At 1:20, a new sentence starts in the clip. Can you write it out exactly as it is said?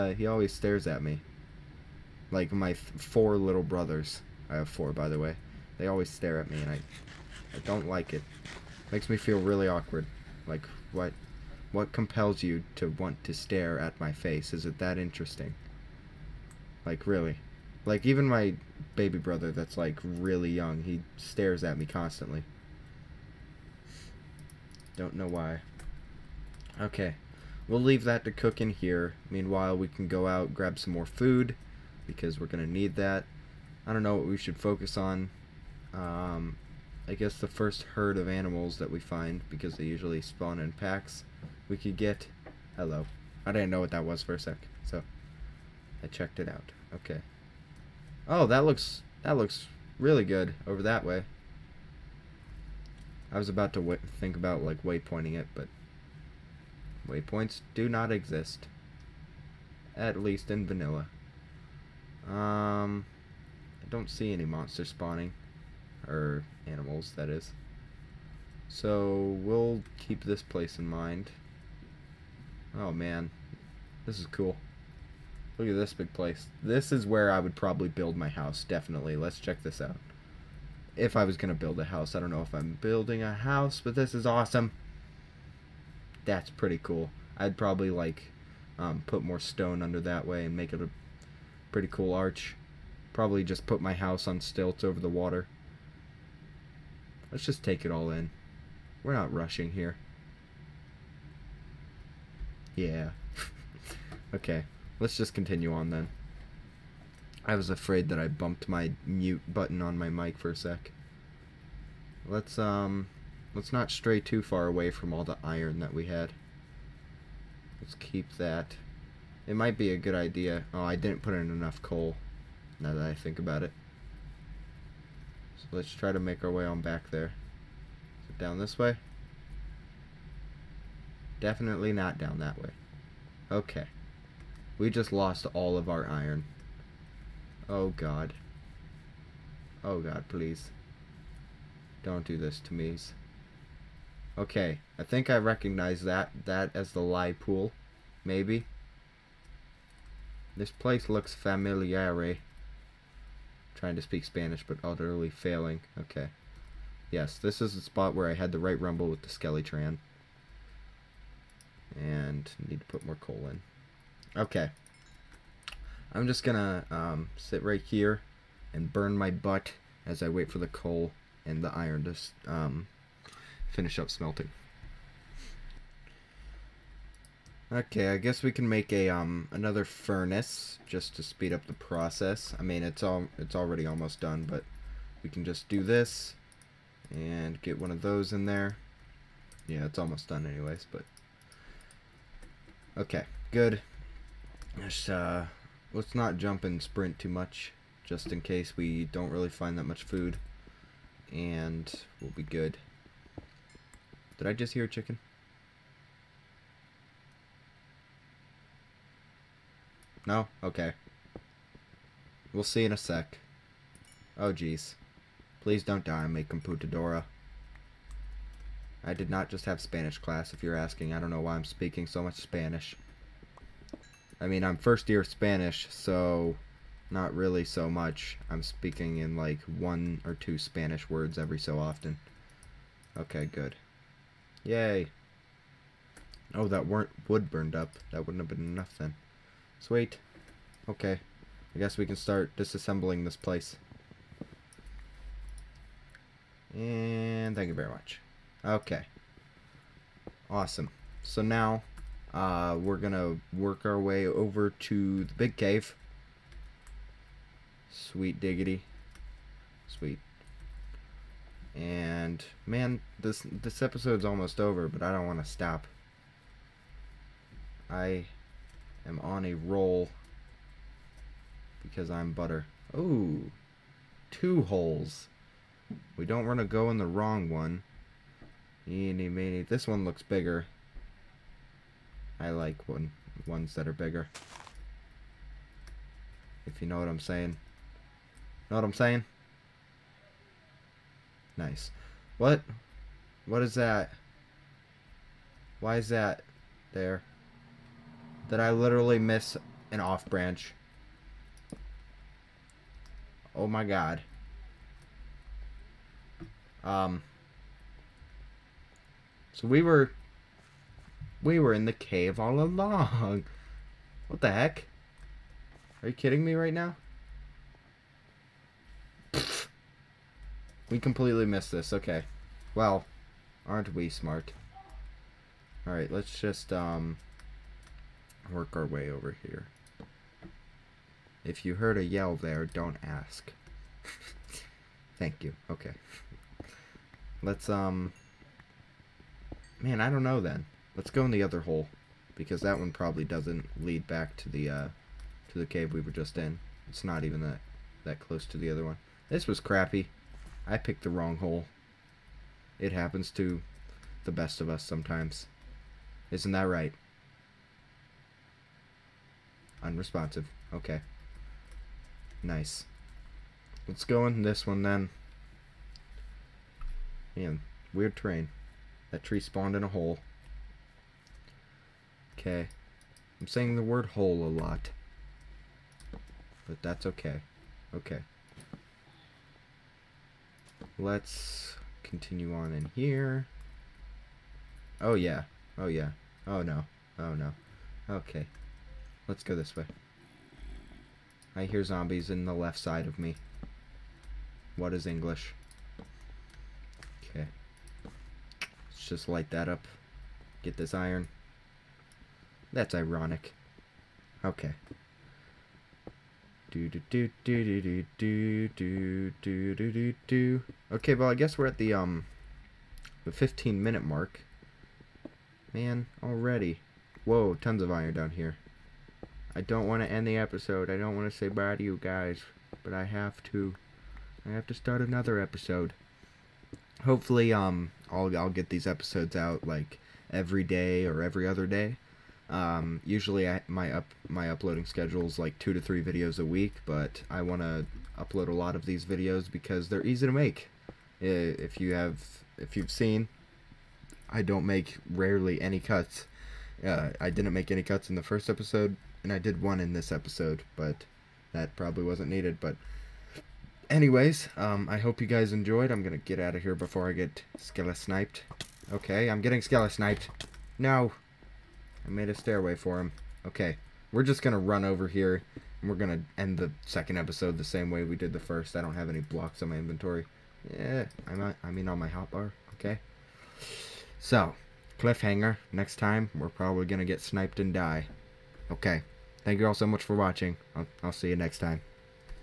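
If I was going to build a house.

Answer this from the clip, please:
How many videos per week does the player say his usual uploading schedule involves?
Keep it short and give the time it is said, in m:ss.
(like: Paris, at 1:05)
2 to 3, at 7:15.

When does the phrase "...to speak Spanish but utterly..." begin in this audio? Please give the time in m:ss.
2:33.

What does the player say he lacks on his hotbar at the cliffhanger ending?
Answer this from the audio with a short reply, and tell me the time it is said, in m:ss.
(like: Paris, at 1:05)
Blocks, at 7:49.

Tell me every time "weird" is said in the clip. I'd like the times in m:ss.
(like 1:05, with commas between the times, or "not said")
6:07.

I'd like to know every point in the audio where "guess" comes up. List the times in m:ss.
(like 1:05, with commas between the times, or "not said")
0:37, 2:58, 4:01, 6:51.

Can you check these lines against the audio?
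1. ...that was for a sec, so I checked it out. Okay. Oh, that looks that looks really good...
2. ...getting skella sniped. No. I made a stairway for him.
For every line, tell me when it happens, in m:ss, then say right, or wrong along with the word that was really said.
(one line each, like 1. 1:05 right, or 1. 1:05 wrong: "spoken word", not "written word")
1. 0:43 right
2. 7:39 right.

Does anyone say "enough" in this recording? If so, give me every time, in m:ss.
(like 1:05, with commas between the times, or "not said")
2:01, 3:58.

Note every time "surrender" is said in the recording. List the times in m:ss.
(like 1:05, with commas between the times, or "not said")
not said.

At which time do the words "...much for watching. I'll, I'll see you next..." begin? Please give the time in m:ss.
7:59.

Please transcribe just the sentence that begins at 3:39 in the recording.
I did not just have Spanish class, if you're asking.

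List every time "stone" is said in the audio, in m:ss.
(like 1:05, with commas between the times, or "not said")
1:29.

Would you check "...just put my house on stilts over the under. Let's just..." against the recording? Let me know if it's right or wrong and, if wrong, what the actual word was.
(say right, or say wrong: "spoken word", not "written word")
wrong: "water", not "under".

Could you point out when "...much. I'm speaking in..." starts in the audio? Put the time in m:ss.
3:47.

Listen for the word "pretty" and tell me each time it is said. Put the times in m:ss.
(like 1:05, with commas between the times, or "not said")
1:26, 1:31.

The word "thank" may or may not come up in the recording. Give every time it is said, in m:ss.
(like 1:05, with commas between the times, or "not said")
4:07, 5:35, 7:59.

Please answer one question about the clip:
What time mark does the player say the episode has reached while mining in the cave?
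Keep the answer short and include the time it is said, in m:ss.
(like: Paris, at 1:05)
15 minutes, at 6:53.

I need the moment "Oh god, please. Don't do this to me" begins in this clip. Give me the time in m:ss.
2:19.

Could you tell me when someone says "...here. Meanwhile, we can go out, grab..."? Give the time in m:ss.
0:28.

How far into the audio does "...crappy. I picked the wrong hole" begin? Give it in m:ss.
5:49.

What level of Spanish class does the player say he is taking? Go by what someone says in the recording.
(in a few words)
First year.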